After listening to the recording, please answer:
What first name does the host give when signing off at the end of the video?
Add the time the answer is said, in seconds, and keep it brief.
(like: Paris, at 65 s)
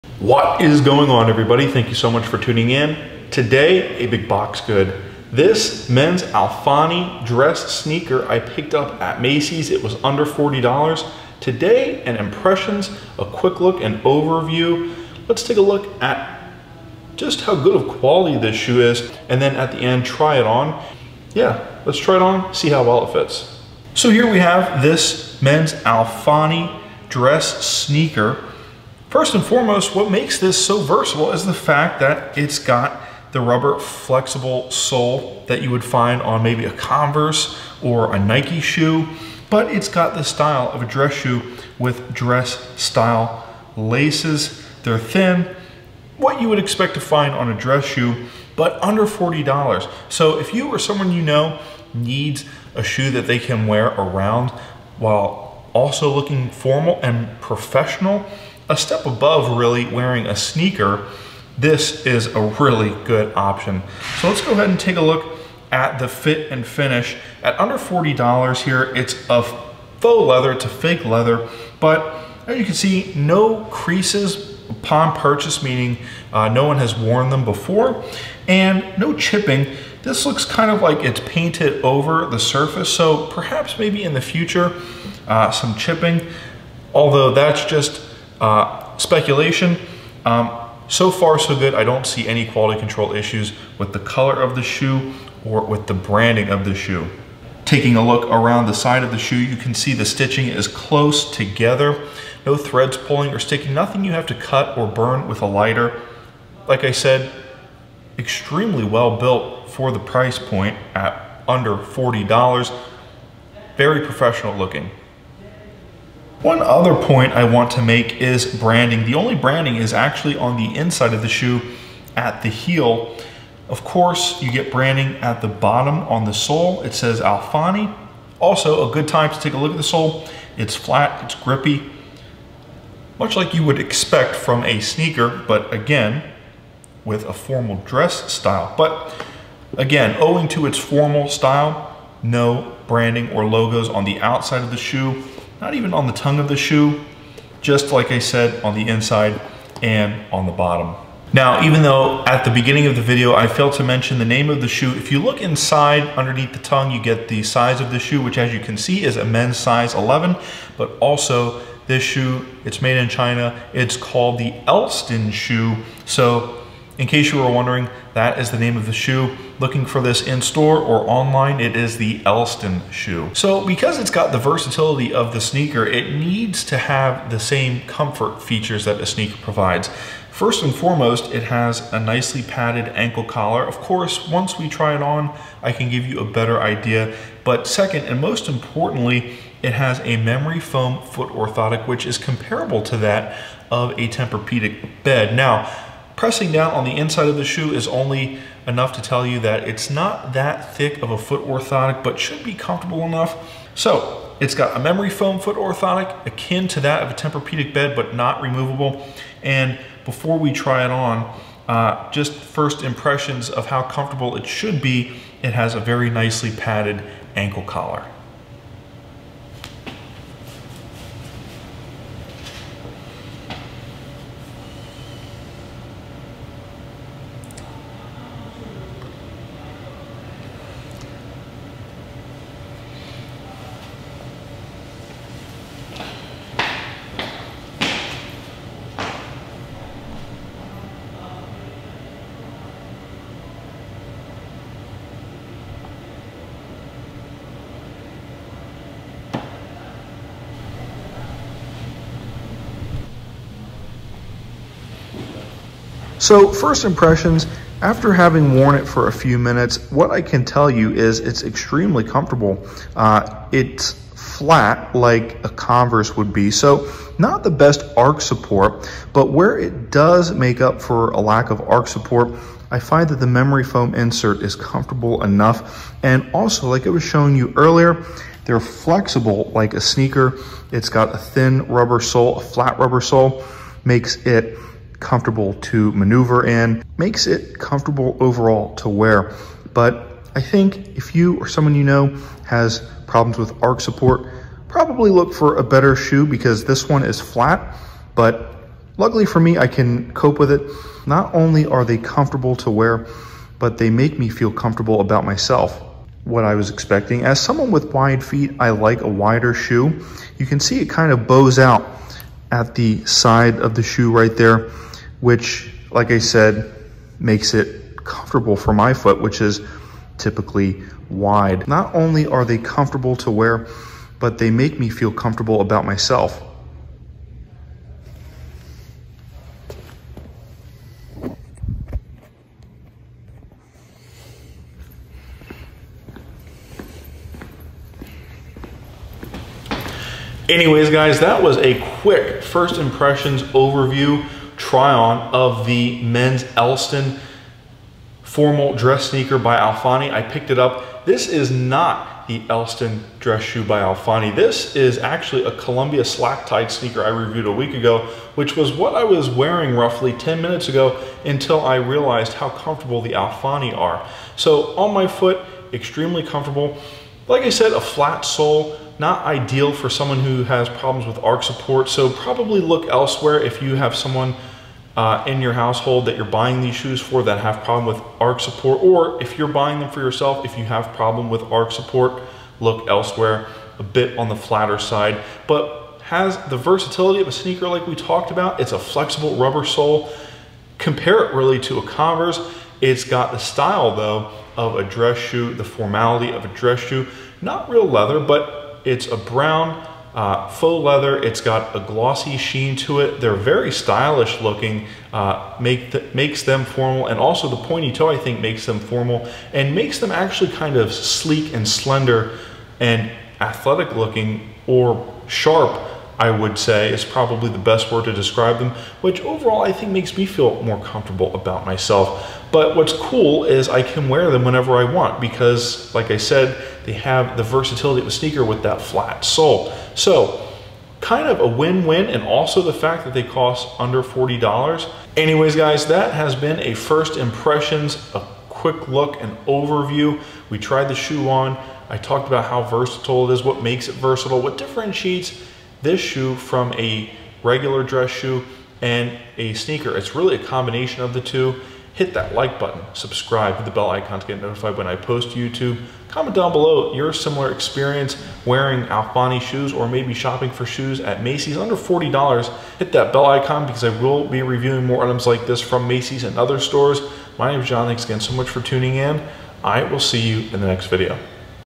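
John, at 467 s.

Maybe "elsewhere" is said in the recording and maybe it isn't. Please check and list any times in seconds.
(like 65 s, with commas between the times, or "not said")
372 s, 382 s.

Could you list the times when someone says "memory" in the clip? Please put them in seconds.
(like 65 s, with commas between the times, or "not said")
190 s, 204 s, 273 s.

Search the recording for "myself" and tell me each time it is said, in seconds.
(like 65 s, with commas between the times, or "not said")
305 s, 325 s, 421 s.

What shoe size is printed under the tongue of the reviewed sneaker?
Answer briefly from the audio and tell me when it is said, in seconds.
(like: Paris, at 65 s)
11, at 159 s.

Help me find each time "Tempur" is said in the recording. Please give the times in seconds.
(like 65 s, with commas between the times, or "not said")
194 s, 207 s.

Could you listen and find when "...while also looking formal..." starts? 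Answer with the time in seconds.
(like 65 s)
54 s.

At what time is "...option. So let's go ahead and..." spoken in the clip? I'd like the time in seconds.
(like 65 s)
63 s.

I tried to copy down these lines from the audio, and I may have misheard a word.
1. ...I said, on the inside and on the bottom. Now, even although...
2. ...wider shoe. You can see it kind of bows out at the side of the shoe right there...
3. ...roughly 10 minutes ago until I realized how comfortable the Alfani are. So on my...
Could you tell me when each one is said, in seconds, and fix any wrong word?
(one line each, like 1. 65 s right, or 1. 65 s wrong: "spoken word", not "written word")
1. 148 s wrong: "though", not "although"
2. 309 s right
3. 359 s right.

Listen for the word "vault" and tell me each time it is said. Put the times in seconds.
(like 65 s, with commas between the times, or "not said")
not said.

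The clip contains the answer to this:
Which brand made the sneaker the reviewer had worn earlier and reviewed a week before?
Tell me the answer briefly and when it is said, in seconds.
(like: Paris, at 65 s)
Columbia, at 355 s.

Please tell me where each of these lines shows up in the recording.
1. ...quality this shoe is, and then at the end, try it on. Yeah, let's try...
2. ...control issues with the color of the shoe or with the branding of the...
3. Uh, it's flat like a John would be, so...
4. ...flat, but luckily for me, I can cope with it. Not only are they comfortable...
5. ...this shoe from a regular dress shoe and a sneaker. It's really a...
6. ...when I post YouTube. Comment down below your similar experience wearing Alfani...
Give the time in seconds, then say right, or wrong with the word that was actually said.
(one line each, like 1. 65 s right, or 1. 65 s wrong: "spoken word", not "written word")
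1. 17 s right
2. 92 s right
3. 262 s wrong: "Converse", not "John"
4. 297 s right
5. 445 s right
6. 454 s right.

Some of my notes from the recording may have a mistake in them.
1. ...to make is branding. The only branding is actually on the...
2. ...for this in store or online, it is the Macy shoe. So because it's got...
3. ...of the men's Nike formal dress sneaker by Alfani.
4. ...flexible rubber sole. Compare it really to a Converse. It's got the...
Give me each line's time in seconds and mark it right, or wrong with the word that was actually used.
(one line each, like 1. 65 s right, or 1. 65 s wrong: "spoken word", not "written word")
1. 117 s right
2. 169 s wrong: "Elston", not "Macy"
3. 345 s wrong: "Elston", not "Nike"
4. 388 s right.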